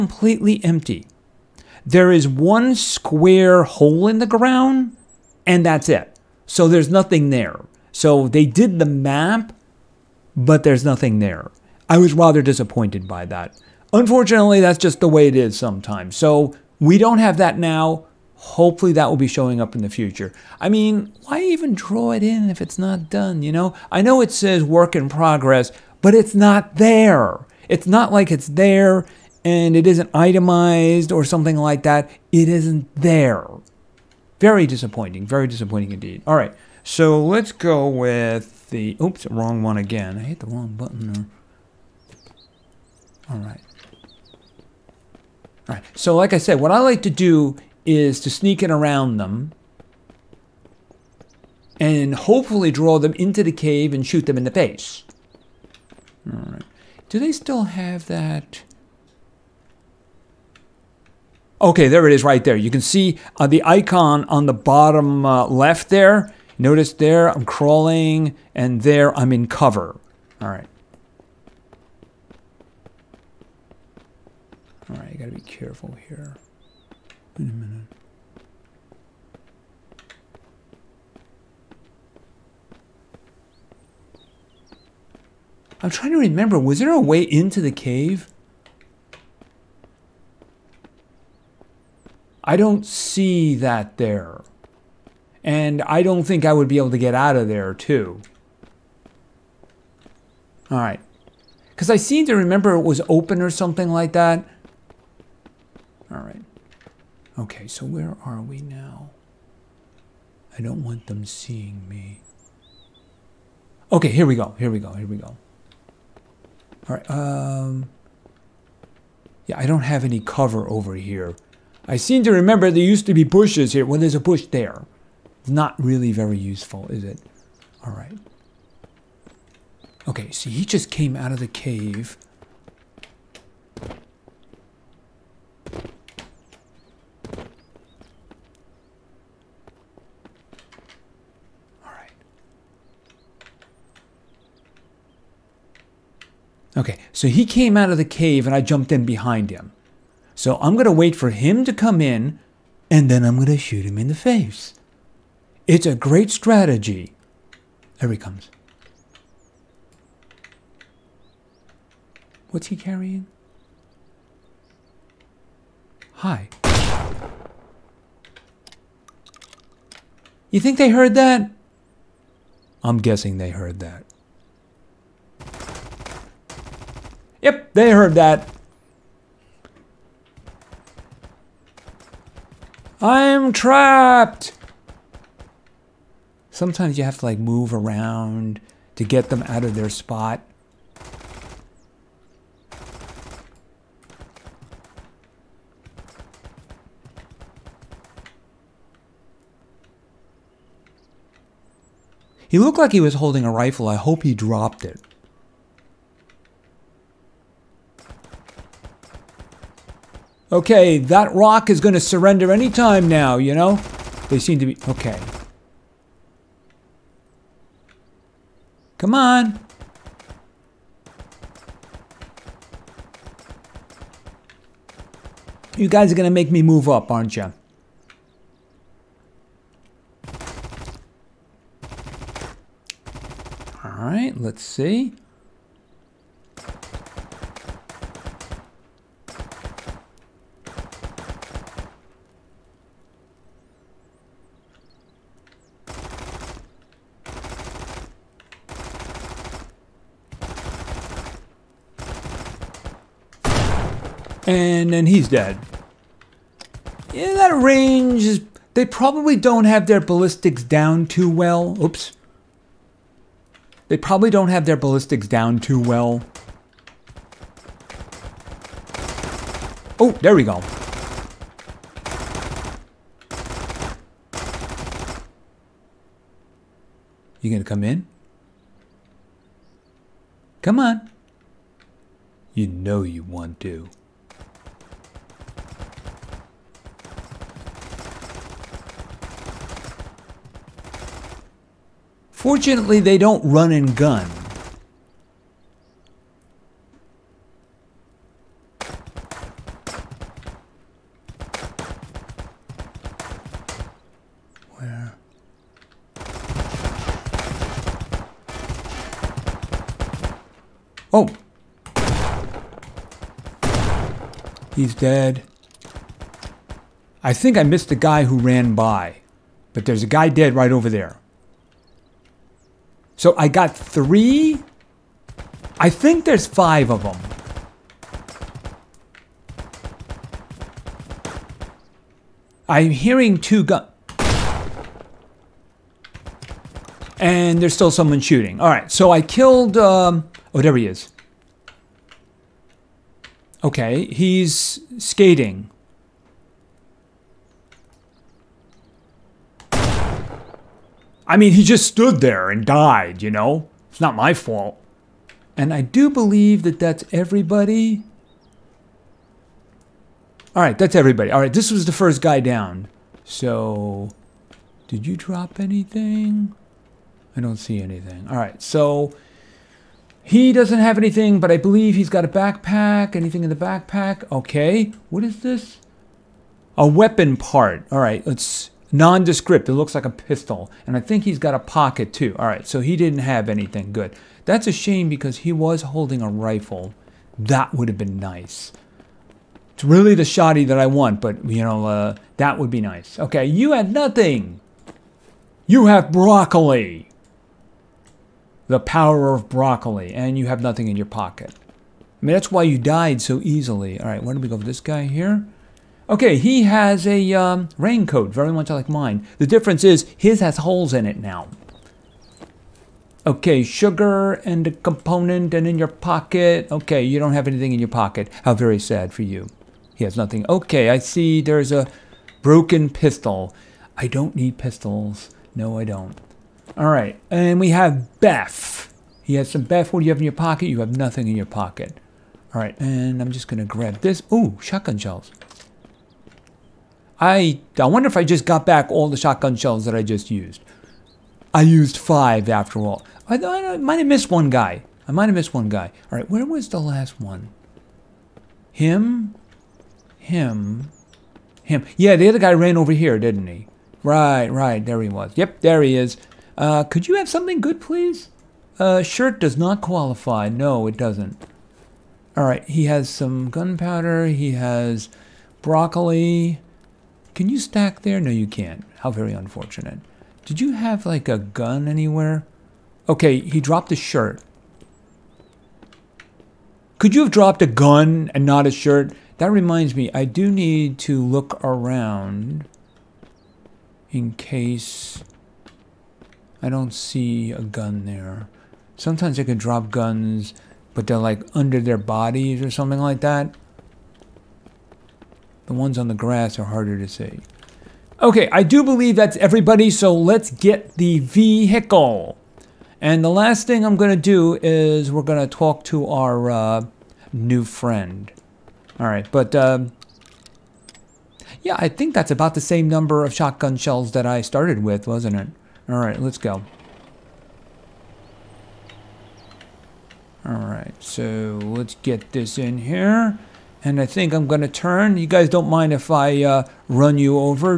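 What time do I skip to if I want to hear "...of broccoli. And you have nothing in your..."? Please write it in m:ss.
6:39.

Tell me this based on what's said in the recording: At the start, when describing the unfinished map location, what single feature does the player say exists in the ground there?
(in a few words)
One square hole.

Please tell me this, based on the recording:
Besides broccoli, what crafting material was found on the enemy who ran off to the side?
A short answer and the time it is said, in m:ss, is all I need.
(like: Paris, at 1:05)
Gunpowder, at 7:43.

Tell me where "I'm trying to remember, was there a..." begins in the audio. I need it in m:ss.
1:25.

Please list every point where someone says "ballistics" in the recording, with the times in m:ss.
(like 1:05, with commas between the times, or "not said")
4:20, 4:24.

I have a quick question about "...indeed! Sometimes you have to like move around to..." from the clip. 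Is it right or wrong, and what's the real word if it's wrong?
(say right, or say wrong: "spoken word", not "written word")
wrong: "trapped", not "indeed".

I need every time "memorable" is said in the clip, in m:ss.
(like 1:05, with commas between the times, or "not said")
not said.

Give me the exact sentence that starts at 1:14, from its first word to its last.
All right, you gotta be careful here.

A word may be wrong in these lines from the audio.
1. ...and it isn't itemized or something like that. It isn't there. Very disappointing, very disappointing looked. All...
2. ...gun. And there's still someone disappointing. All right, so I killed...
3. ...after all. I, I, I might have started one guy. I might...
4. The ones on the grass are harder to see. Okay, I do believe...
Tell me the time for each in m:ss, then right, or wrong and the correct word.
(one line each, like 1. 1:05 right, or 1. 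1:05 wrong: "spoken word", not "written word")
1. 0:29 wrong: "indeed", not "looked"
2. 5:33 wrong: "shooting", not "disappointing"
3. 7:22 wrong: "missed", not "started"
4. 8:15 right.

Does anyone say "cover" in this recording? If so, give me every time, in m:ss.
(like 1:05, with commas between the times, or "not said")
1:09, 2:00.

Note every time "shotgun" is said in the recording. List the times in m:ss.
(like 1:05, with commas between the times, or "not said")
7:14, 7:19, 8:33.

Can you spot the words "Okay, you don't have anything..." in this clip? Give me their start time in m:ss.
6:56.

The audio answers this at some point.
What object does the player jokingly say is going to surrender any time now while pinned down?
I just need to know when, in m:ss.
3:30.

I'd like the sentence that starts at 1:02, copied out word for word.
You can see uh, the icon on the bottom uh, left there.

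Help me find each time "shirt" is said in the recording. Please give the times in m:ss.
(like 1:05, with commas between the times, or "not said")
7:39, 7:53, 7:58.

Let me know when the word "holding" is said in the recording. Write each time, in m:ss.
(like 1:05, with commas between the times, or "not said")
3:23, 6:25.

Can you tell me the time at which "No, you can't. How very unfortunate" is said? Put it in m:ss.
7:48.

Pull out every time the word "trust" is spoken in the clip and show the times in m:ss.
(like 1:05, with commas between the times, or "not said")
not said.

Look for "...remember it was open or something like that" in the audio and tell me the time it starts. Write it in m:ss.
1:42.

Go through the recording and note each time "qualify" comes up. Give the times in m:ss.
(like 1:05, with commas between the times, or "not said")
7:39.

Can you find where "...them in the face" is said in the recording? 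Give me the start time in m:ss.
0:54.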